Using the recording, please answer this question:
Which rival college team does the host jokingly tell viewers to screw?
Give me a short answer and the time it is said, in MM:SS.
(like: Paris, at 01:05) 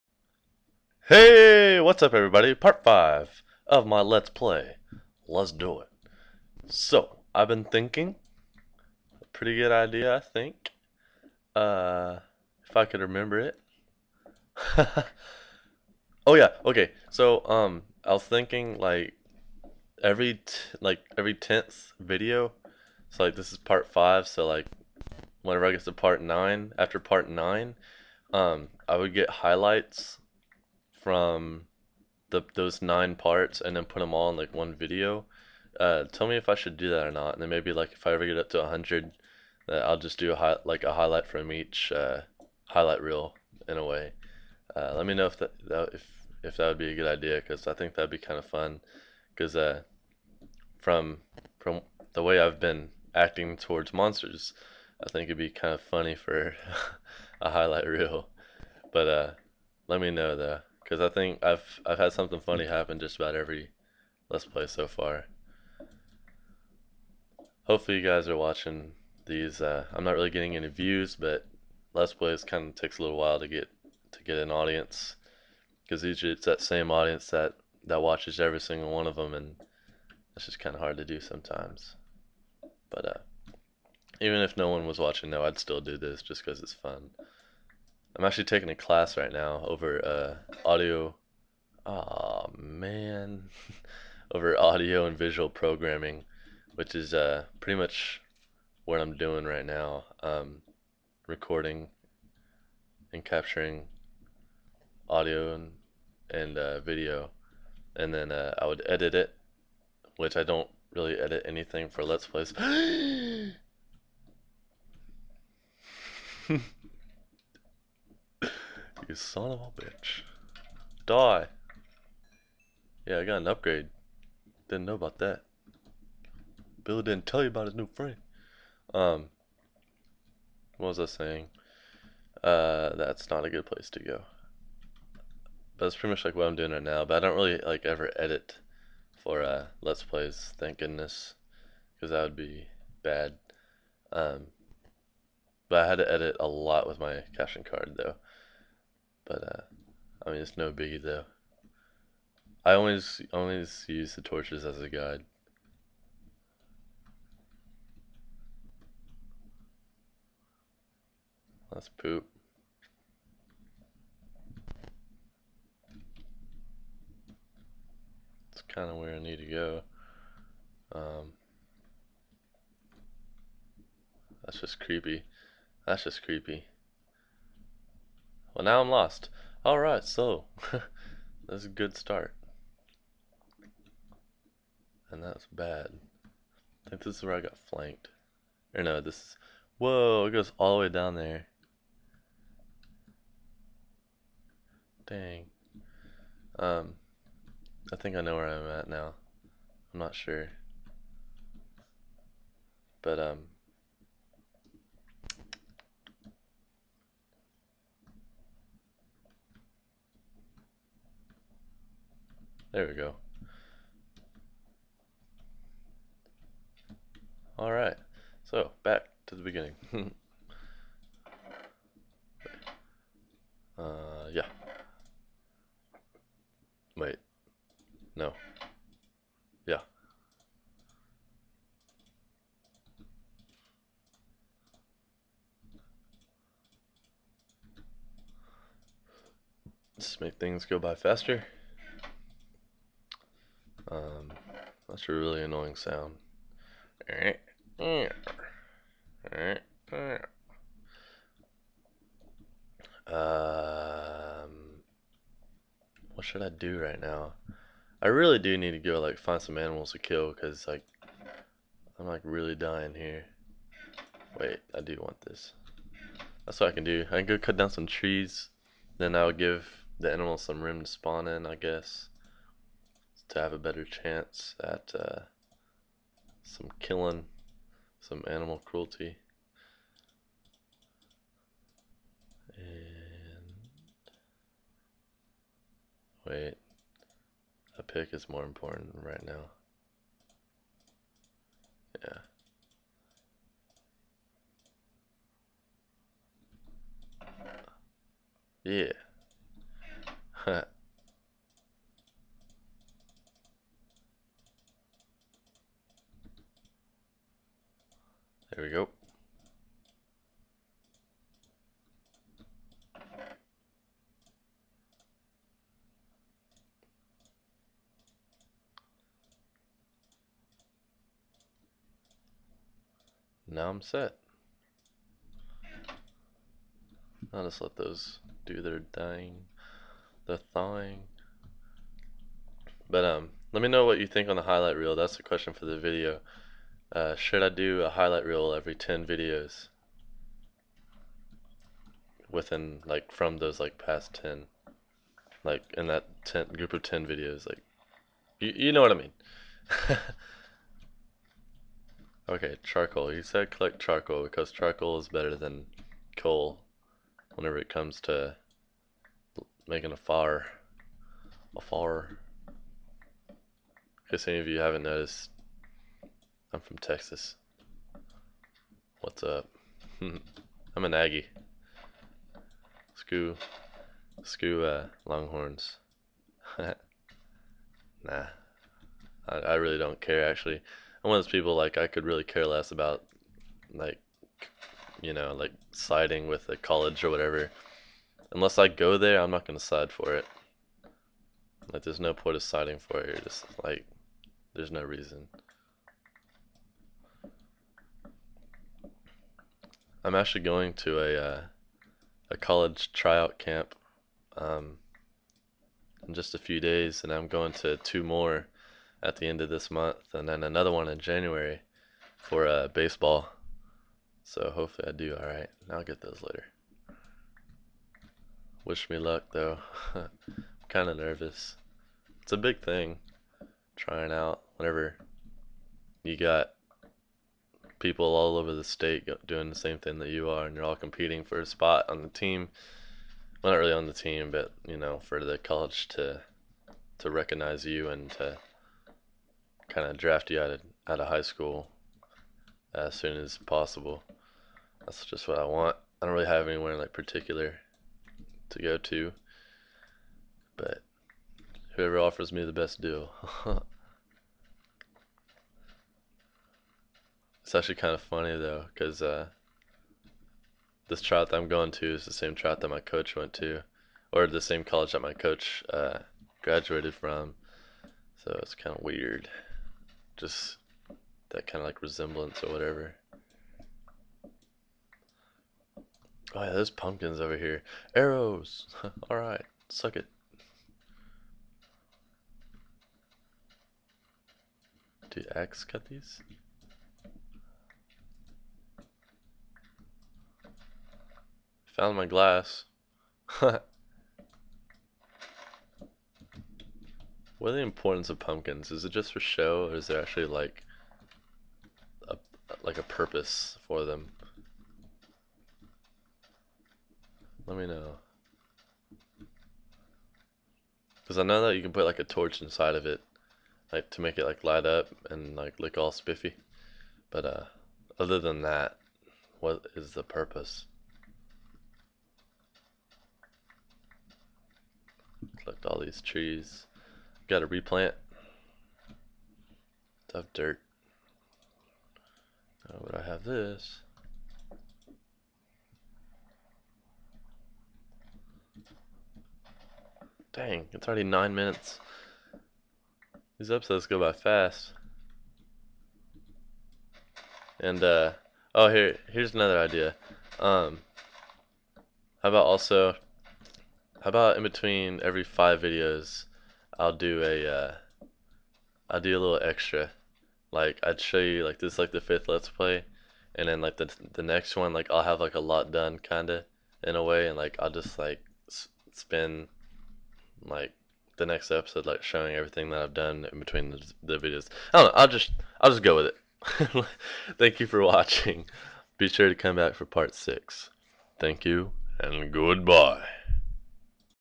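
Longhorns, at 06:15.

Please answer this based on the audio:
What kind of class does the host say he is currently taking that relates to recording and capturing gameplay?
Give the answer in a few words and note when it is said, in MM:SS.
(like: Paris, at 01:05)
audio and visual programming, at 01:34.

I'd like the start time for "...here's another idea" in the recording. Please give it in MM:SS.
09:09.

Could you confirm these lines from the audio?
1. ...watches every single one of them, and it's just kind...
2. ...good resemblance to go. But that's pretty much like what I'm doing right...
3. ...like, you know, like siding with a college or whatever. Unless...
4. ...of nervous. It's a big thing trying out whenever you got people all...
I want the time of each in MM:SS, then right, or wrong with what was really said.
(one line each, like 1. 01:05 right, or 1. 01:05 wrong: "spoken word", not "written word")
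1. 01:18 right
2. 02:13 wrong: "place", not "resemblance"
3. 06:23 right
4. 07:00 right.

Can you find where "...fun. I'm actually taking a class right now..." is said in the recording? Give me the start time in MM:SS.
01:26.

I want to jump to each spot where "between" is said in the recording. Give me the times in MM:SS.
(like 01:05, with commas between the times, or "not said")
09:14, 09:33.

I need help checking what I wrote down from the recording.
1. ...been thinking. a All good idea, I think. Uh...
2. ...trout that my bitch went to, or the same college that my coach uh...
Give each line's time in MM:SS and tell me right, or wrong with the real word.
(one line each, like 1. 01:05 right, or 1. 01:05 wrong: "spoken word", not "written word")
1. 00:07 wrong: "Pretty", not "All"
2. 07:42 wrong: "coach", not "bitch".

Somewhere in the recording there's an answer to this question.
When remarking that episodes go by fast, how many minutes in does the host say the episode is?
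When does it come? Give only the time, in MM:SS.
09:01.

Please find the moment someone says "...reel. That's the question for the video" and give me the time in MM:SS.
05:34.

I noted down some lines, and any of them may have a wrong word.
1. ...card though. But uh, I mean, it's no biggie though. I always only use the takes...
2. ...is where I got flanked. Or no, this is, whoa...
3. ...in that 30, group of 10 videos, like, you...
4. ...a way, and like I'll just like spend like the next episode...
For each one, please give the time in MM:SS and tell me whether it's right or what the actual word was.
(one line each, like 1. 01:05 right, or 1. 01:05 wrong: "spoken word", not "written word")
1. 02:27 wrong: "torches", not "takes"
2. 03:07 right
3. 05:45 wrong: "10", not "30"
4. 09:26 right.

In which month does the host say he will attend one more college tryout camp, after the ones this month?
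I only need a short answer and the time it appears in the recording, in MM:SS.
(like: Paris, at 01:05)
January, at 06:50.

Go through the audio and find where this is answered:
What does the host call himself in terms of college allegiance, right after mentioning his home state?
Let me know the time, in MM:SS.
06:10.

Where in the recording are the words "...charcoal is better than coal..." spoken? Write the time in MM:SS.
05:54.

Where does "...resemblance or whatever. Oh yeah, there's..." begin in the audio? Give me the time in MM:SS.
07:51.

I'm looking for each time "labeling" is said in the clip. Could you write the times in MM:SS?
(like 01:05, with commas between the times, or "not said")
not said.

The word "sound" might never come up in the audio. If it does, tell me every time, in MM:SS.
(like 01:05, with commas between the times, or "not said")
04:05.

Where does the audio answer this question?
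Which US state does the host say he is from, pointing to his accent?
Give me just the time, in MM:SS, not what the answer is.
06:06.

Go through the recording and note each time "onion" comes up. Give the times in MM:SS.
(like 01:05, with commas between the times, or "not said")
not said.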